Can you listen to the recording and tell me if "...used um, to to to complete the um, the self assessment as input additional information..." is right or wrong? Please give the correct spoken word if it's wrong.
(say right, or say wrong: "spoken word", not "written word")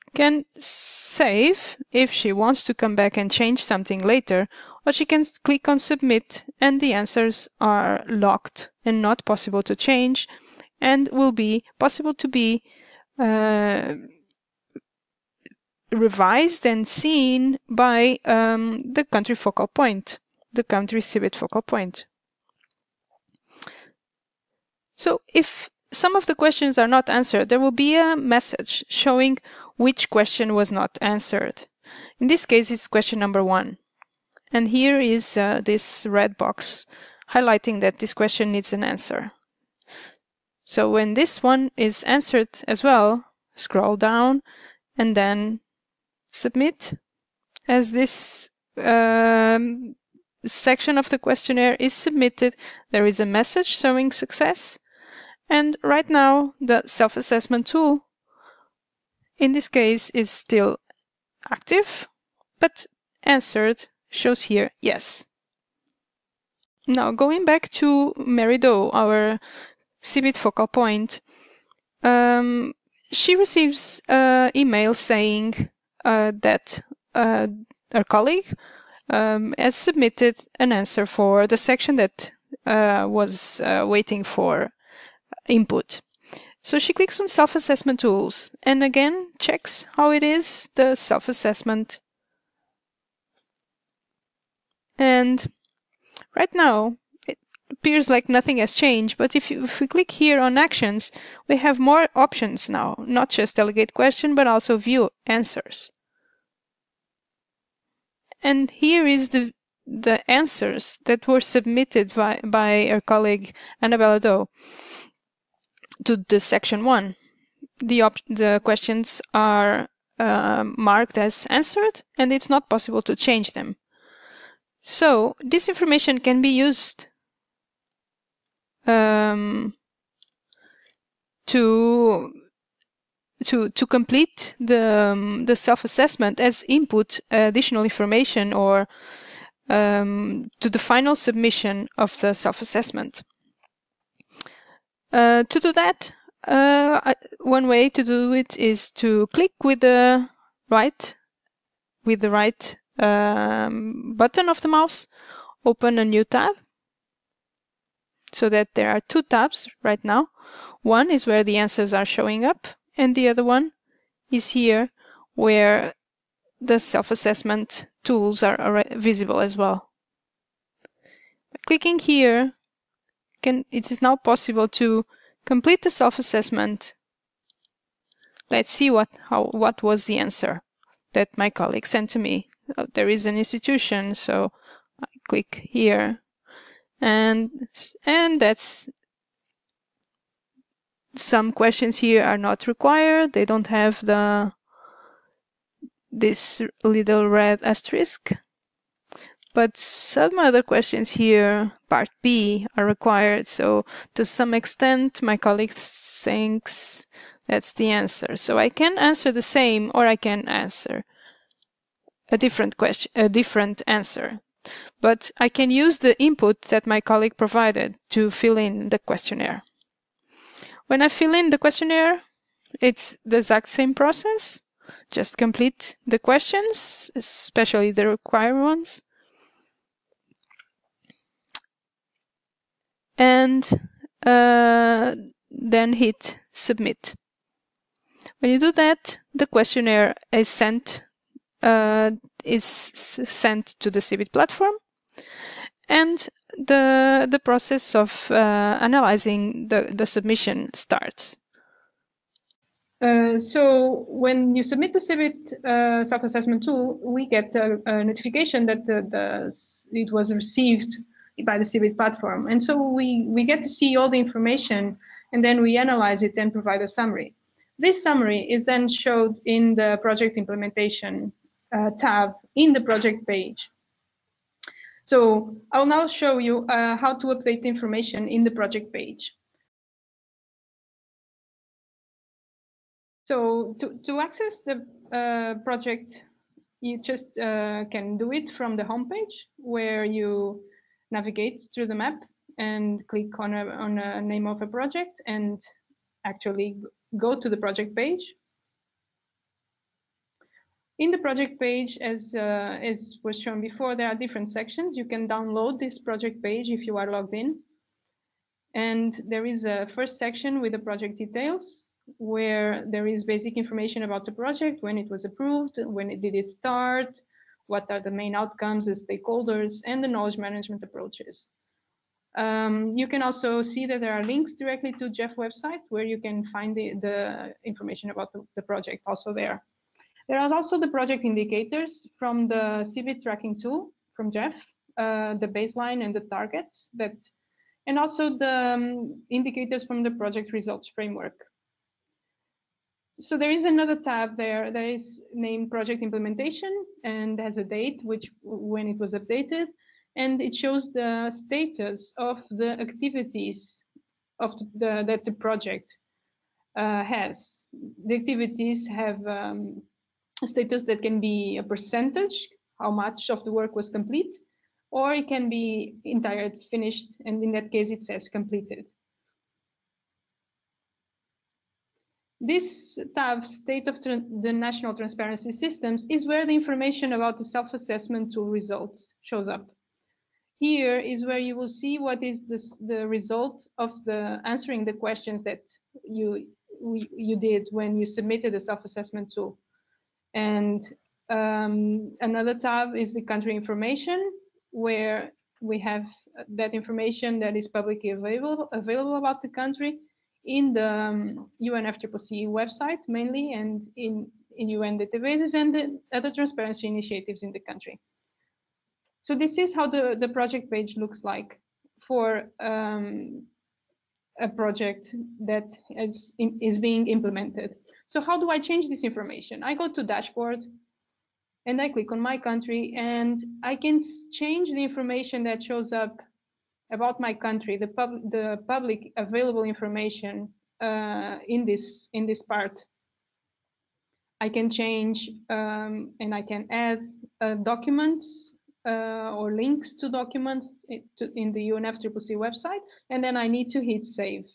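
right.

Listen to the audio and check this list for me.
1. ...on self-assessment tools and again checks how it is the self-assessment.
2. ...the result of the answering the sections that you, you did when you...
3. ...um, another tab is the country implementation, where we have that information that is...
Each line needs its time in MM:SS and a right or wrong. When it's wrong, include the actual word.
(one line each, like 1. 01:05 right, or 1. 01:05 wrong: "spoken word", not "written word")
1. 01:27 right
2. 06:22 wrong: "questions", not "sections"
3. 06:31 wrong: "information", not "implementation".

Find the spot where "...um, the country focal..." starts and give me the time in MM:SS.
00:18.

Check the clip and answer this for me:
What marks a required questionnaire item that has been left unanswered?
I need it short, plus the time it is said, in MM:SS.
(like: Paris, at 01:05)
red box, at 00:36.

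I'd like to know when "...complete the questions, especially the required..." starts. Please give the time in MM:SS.
03:45.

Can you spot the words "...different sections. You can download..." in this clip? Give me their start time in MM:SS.
05:04.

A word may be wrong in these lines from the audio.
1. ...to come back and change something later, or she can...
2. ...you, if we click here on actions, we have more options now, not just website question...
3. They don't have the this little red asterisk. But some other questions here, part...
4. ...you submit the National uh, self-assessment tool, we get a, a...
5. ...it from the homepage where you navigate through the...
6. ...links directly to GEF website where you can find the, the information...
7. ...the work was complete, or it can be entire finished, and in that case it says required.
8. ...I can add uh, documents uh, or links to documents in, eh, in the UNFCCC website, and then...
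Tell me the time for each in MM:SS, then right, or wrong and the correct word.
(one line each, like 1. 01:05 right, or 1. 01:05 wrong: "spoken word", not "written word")
1. 00:02 right
2. 01:39 wrong: "delegate", not "website"
3. 03:13 right
4. 04:14 wrong: "CBIT", not "National"
5. 04:48 right
6. 05:24 right
7. 06:03 wrong: "completed", not "required"
8. 07:16 right.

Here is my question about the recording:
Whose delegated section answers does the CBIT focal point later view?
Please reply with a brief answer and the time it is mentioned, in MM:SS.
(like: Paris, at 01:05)
Annabella Doe, at 01:53.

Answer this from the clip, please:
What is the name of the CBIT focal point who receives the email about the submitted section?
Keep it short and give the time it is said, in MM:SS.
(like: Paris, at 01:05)
Mary Doe, at 01:08.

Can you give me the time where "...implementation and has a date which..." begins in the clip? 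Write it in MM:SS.
05:46.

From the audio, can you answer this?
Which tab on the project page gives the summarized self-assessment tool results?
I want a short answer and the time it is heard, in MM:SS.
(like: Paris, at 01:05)
State of the National Transparency Systems, at 06:13.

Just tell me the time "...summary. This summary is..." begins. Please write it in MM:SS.
04:26.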